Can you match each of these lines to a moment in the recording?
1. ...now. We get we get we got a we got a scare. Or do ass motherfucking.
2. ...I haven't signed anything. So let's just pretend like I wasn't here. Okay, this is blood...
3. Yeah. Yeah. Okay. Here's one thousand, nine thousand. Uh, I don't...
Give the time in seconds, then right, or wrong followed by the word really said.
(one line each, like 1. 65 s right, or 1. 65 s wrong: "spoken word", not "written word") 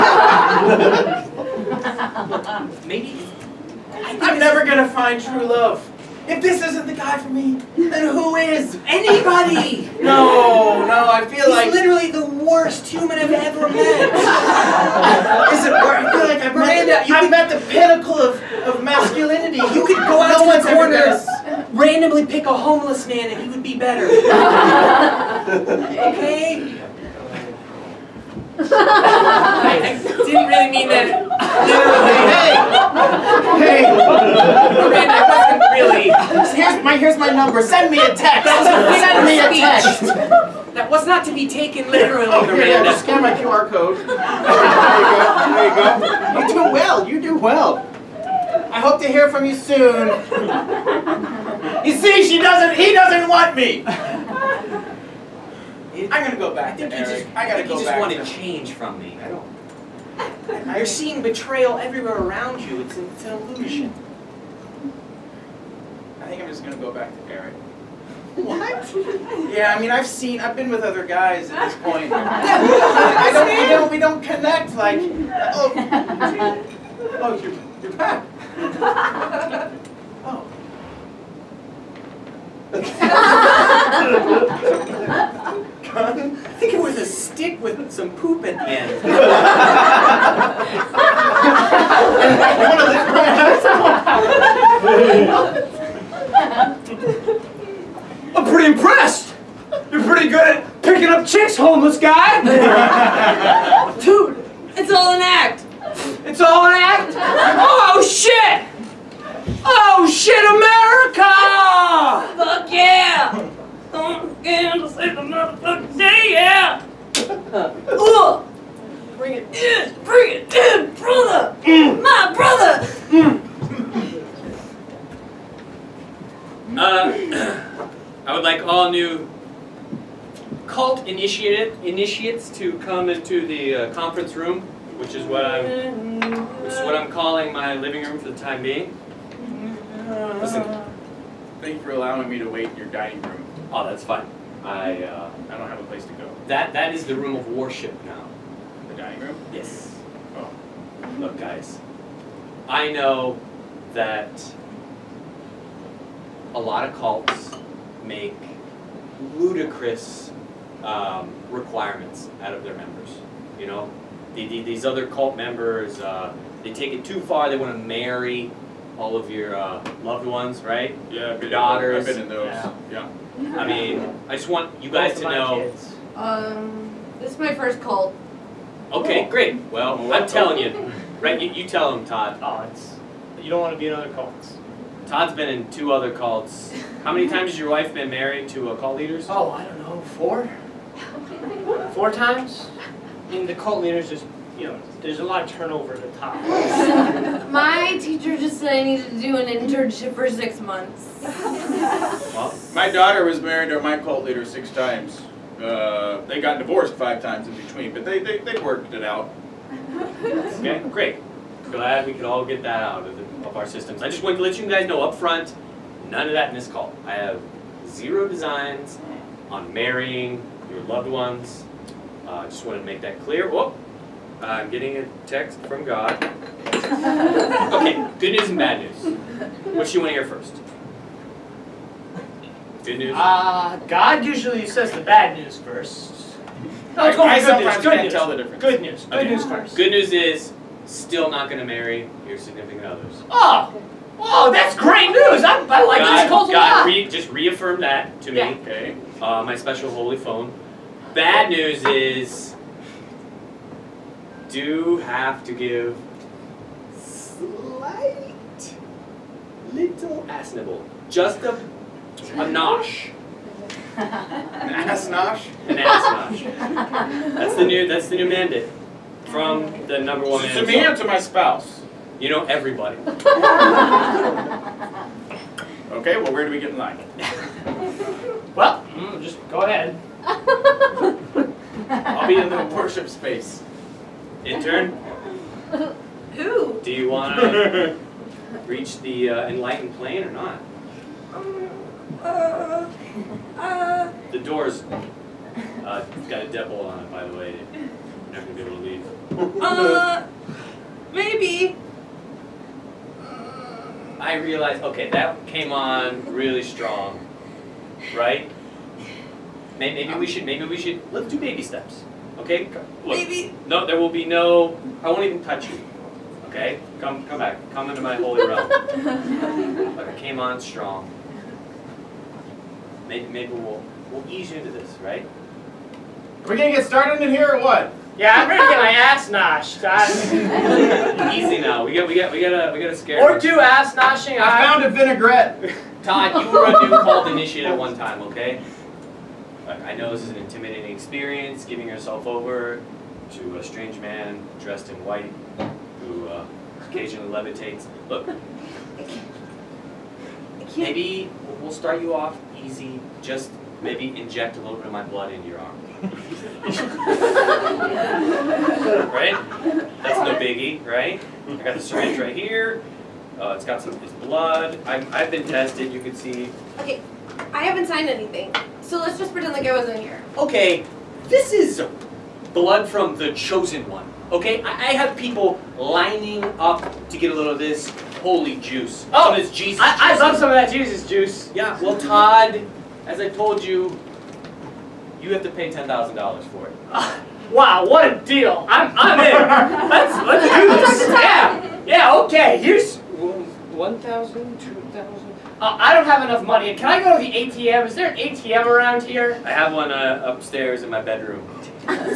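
1. 331 s wrong: "noshing", not "motherfucking"
2. 367 s right
3. 391 s wrong: "two", not "nine".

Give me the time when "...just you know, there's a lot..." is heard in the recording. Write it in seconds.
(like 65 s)
194 s.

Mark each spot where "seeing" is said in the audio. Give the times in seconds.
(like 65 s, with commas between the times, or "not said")
60 s.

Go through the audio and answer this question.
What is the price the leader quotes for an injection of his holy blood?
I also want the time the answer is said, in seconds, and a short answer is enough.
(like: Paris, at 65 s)
$10,000, at 385 s.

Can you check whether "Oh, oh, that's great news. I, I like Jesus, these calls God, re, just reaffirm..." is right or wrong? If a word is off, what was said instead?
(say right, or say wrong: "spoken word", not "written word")
wrong: "God", not "Jesus".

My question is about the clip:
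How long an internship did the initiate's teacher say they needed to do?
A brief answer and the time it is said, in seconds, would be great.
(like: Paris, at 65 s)
six months, at 200 s.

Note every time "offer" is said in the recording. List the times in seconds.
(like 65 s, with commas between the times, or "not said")
not said.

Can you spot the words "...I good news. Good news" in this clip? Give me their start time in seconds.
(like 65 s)
237 s.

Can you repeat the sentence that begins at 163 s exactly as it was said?
You know, the, the, these other cult members, uh, they take it too far.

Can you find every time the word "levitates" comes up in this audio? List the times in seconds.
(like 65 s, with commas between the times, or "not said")
347 s.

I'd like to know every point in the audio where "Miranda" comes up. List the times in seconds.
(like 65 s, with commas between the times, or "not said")
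16 s, 33 s, 42 s.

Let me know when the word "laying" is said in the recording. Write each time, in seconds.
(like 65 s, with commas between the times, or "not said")
not said.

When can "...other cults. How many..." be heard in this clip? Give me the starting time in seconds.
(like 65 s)
185 s.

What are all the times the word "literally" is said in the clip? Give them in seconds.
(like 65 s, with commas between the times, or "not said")
11 s, 41 s.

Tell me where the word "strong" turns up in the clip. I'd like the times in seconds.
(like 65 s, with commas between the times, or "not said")
306 s, 320 s.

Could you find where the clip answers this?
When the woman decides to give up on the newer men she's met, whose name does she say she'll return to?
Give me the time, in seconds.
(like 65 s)
67 s.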